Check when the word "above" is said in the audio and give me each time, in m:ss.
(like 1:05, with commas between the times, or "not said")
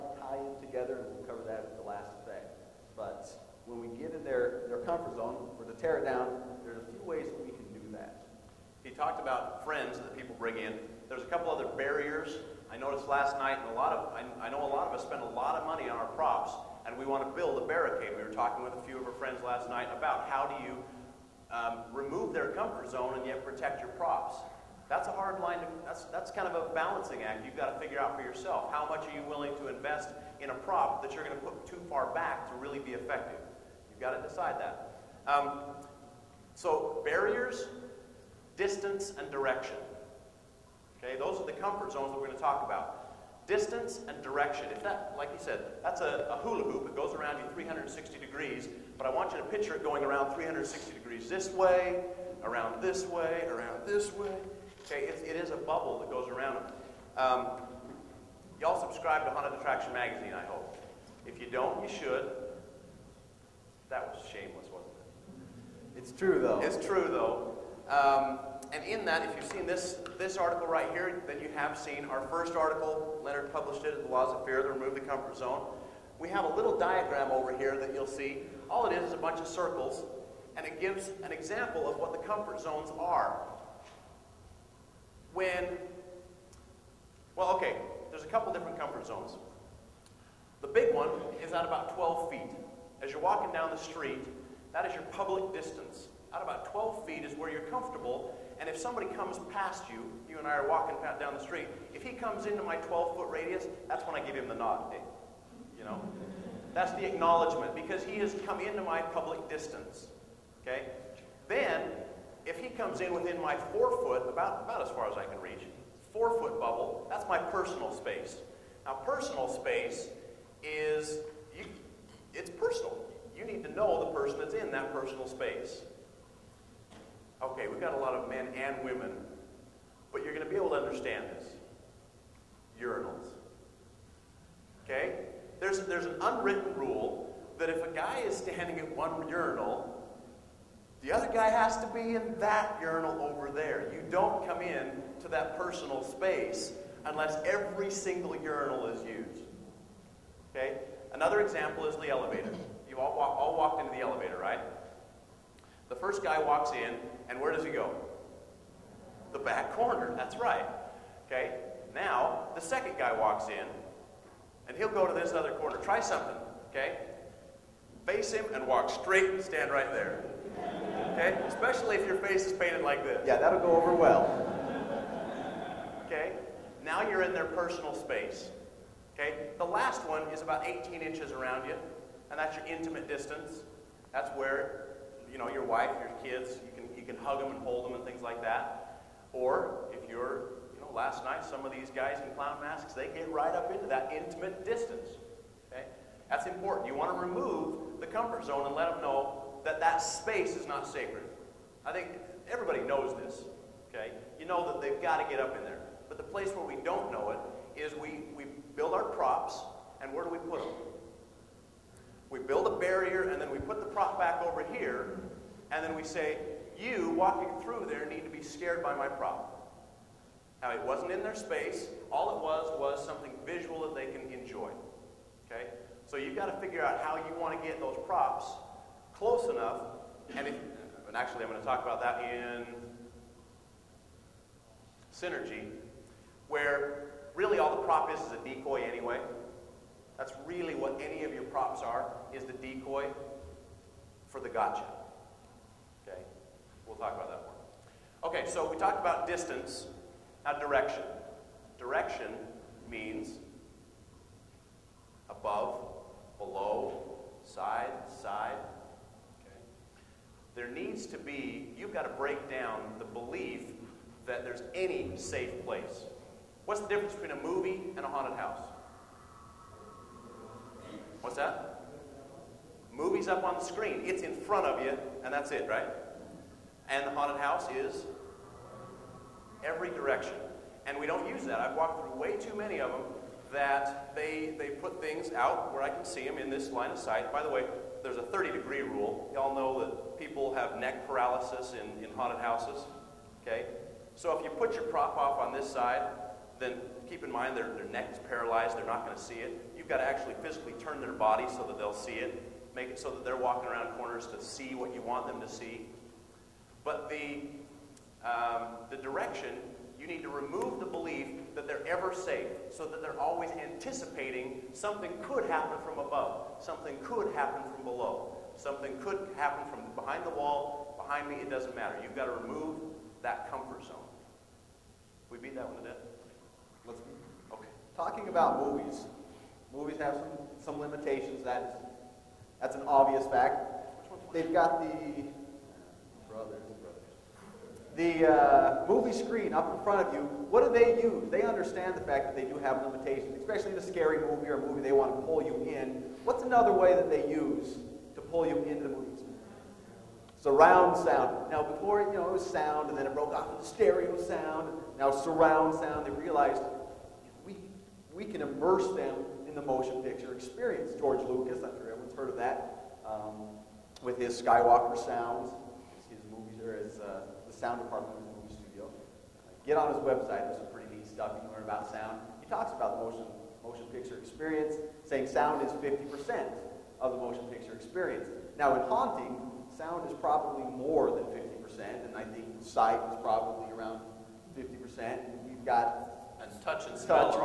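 4:15, 5:15.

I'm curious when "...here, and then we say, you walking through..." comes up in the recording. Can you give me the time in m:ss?
3:34.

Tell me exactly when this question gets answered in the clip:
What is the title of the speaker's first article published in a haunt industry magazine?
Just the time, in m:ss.
1:14.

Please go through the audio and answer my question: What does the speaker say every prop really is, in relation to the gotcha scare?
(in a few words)
a decoy.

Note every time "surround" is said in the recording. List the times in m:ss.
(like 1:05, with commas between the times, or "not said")
5:50, 5:55.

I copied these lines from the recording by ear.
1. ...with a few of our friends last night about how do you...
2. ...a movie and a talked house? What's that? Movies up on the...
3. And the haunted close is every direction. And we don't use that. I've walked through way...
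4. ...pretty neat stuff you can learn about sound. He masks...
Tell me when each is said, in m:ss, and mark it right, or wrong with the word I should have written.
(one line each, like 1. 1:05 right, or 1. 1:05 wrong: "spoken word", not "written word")
1. 0:18 right
2. 4:27 wrong: "haunted", not "talked"
3. 4:36 wrong: "house", not "close"
4. 6:10 wrong: "talks", not "masks".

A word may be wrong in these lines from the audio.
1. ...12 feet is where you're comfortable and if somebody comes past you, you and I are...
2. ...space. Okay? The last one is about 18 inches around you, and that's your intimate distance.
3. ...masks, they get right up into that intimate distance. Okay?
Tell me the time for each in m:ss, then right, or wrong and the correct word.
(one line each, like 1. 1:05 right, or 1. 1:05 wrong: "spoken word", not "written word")
1. 1:36 right
2. 2:57 right
3. 3:12 right.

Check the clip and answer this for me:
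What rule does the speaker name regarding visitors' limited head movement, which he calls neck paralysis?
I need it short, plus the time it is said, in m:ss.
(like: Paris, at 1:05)
30 degree rule, at 4:48.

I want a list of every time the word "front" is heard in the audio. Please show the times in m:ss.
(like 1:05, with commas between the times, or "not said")
4:34, 5:39.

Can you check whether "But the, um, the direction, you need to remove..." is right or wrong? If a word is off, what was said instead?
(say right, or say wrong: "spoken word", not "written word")
right.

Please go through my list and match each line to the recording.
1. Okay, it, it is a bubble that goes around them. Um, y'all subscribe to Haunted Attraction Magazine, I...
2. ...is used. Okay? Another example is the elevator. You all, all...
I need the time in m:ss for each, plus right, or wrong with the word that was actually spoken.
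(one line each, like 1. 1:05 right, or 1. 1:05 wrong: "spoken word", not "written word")
1. 0:54 right
2. 2:28 right.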